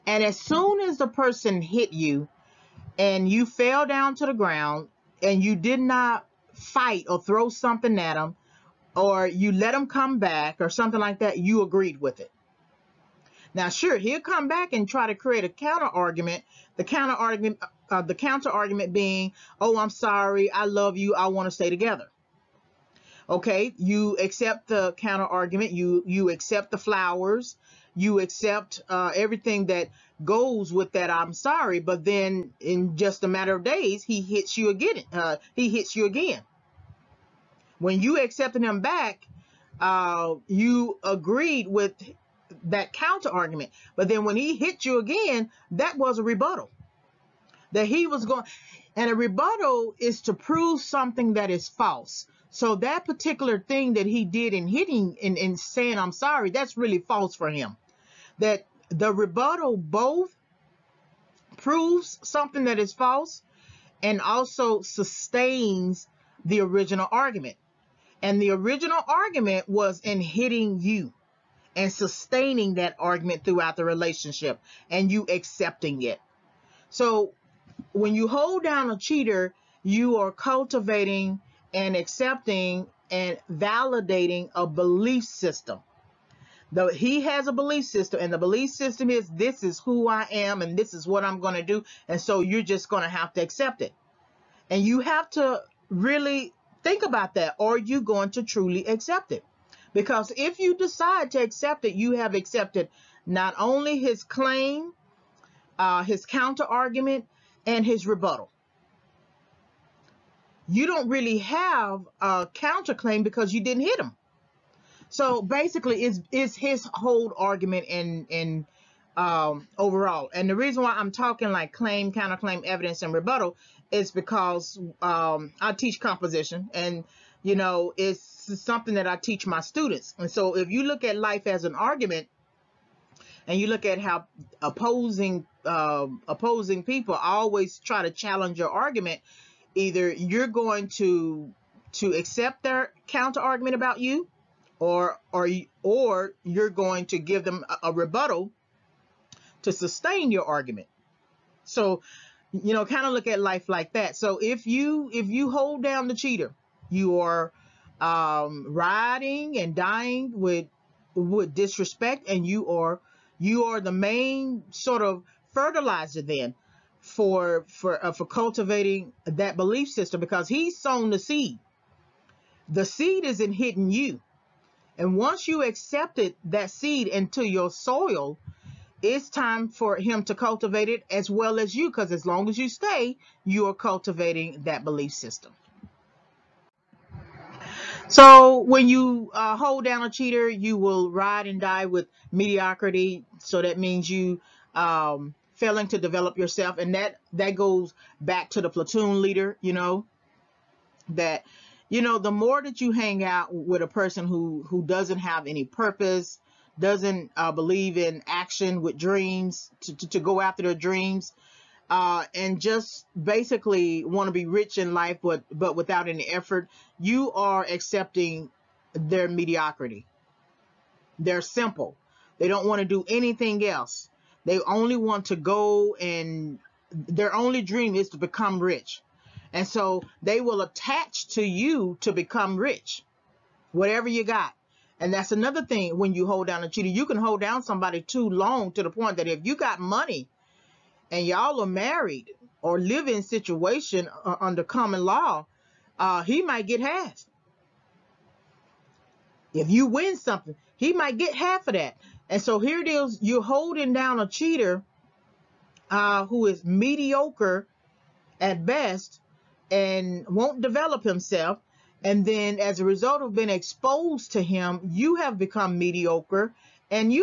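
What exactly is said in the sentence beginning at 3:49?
And so they will attach to you to become rich, whatever you got.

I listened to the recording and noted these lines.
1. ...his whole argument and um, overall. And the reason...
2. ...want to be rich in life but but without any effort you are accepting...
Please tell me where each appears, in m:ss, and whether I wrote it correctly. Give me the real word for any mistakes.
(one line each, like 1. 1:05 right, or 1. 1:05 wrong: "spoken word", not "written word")
1. 1:56 right
2. 3:34 right.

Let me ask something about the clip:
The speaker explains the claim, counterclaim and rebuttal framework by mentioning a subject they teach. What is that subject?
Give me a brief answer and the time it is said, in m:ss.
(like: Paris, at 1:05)
composition, at 2:06.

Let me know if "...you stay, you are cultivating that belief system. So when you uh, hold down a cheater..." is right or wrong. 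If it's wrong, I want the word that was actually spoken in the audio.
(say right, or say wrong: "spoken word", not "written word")
right.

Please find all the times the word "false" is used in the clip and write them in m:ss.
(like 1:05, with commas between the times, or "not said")
0:51, 0:56, 1:02.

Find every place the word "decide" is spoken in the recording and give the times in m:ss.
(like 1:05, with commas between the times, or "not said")
1:40.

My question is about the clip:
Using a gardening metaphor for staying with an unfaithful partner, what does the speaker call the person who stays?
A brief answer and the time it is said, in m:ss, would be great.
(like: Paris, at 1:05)
fertilizer, at 2:45.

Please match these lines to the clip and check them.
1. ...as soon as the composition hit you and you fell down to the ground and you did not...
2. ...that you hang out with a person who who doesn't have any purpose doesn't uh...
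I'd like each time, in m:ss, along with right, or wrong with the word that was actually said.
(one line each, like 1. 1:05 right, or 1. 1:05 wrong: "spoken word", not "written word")
1. 0:00 wrong: "person", not "composition"
2. 3:22 right.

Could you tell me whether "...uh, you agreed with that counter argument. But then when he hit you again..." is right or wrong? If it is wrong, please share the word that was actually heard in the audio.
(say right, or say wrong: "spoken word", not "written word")
right.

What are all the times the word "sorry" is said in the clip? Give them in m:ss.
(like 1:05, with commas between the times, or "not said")
0:19, 0:31, 0:56.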